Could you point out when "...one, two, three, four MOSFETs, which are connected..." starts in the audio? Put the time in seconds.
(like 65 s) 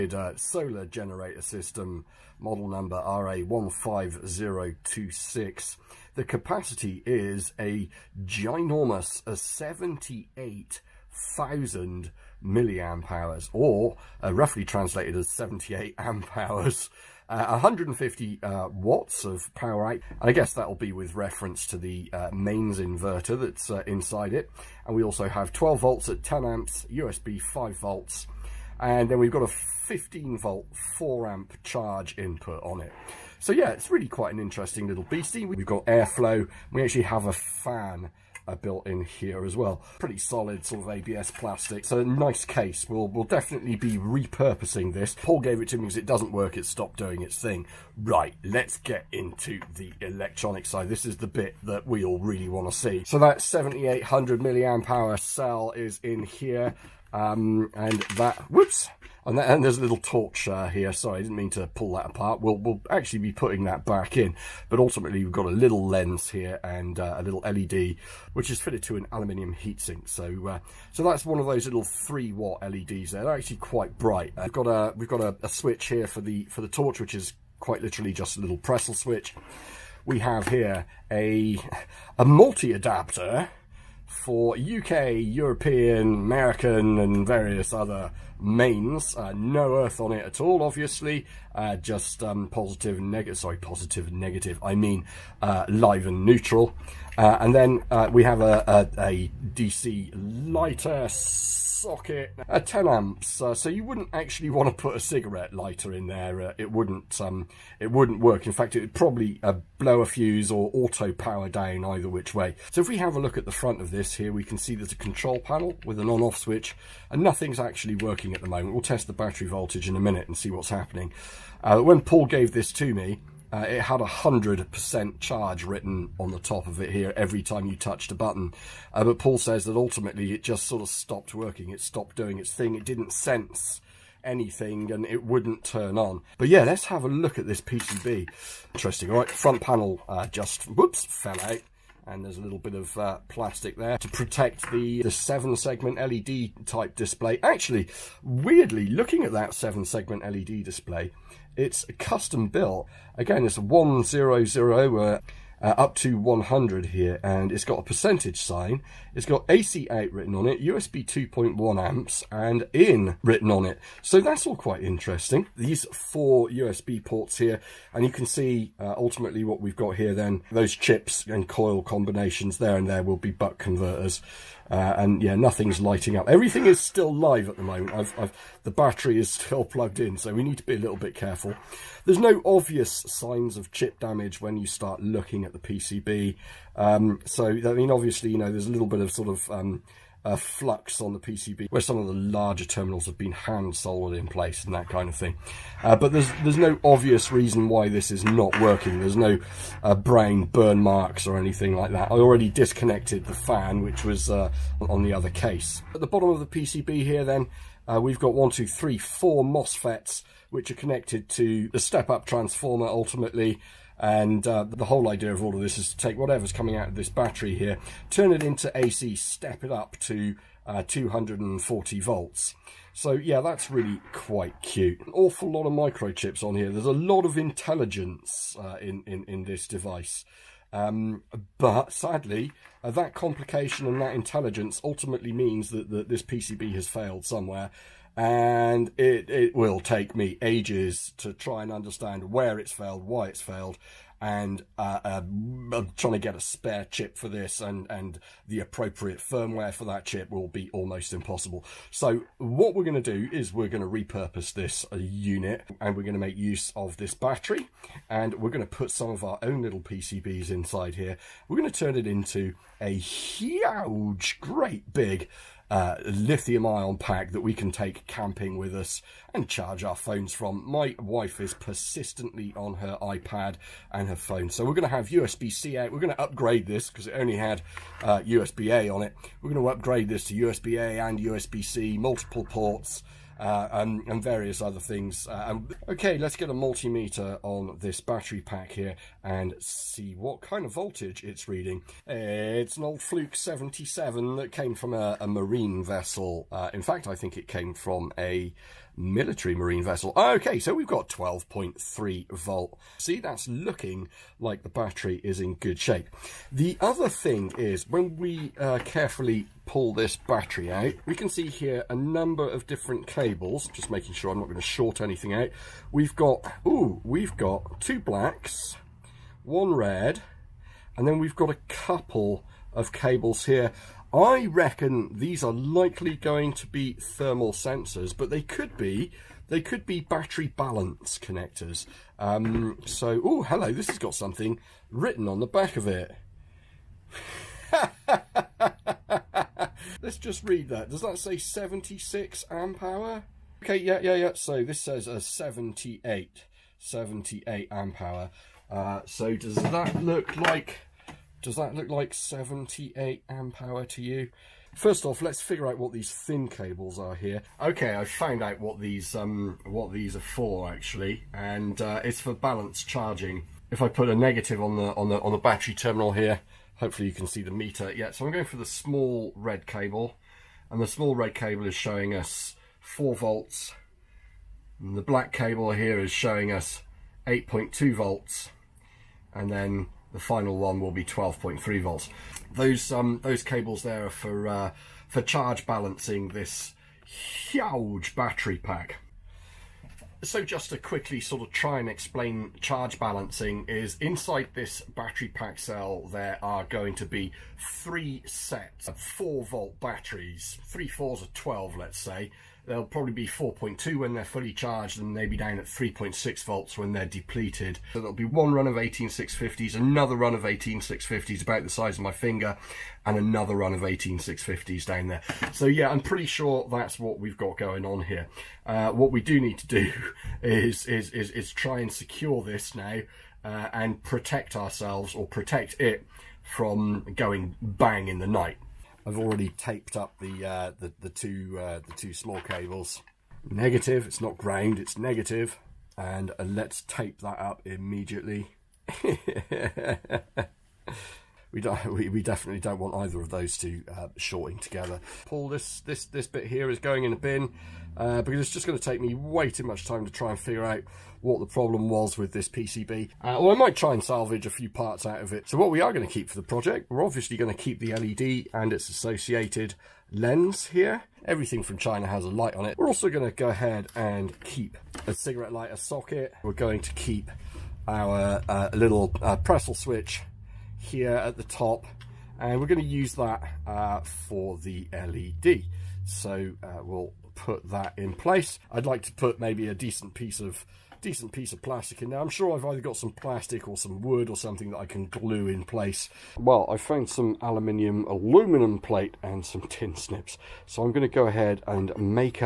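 208 s.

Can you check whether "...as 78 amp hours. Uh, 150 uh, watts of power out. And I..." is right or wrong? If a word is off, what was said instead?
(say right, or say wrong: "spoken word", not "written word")
right.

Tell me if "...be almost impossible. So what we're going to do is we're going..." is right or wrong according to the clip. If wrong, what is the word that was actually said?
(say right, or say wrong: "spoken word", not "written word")
right.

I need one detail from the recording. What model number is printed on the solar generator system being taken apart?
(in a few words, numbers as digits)
RA15026.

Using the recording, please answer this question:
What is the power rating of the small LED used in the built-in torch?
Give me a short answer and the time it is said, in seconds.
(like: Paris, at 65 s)
3 watts, at 71 s.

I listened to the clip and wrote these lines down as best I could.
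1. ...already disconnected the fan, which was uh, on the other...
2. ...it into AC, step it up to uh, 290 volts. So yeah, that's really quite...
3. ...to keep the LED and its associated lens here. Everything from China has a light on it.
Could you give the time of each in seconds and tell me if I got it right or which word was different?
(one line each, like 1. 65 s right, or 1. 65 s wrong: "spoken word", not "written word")
1. 202 s right
2. 218 s wrong: "240", not "290"
3. 457 s right.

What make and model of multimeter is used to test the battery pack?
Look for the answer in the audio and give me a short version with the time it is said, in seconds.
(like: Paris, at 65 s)
Fluke 77, at 293 s.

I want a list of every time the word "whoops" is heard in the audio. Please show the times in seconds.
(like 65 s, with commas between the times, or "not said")
58 s, 140 s.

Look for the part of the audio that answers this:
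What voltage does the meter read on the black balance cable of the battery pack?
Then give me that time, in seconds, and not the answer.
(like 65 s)
377 s.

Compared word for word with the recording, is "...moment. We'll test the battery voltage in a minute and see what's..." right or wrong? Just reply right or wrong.
right.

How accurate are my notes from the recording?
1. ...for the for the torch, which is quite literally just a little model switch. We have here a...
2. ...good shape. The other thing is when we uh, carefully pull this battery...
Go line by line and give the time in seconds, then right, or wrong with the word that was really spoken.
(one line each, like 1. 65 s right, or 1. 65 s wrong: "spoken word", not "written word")
1. 76 s wrong: "pressel", not "model"
2. 305 s right.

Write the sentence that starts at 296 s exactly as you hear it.
Uh, in fact, I think it came from a military marine vessel.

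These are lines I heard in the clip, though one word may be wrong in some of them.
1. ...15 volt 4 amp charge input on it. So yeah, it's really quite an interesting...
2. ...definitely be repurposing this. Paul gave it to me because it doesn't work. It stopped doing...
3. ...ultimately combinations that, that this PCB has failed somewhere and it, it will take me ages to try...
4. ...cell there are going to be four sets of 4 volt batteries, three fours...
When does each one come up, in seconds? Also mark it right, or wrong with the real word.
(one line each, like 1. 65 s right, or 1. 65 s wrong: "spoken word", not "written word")
1. 29 s right
2. 43 s right
3. 234 s wrong: "means", not "combinations"
4. 395 s wrong: "three", not "four".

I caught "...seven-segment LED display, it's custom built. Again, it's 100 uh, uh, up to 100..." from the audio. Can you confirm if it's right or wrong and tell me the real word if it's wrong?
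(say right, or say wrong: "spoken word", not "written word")
right.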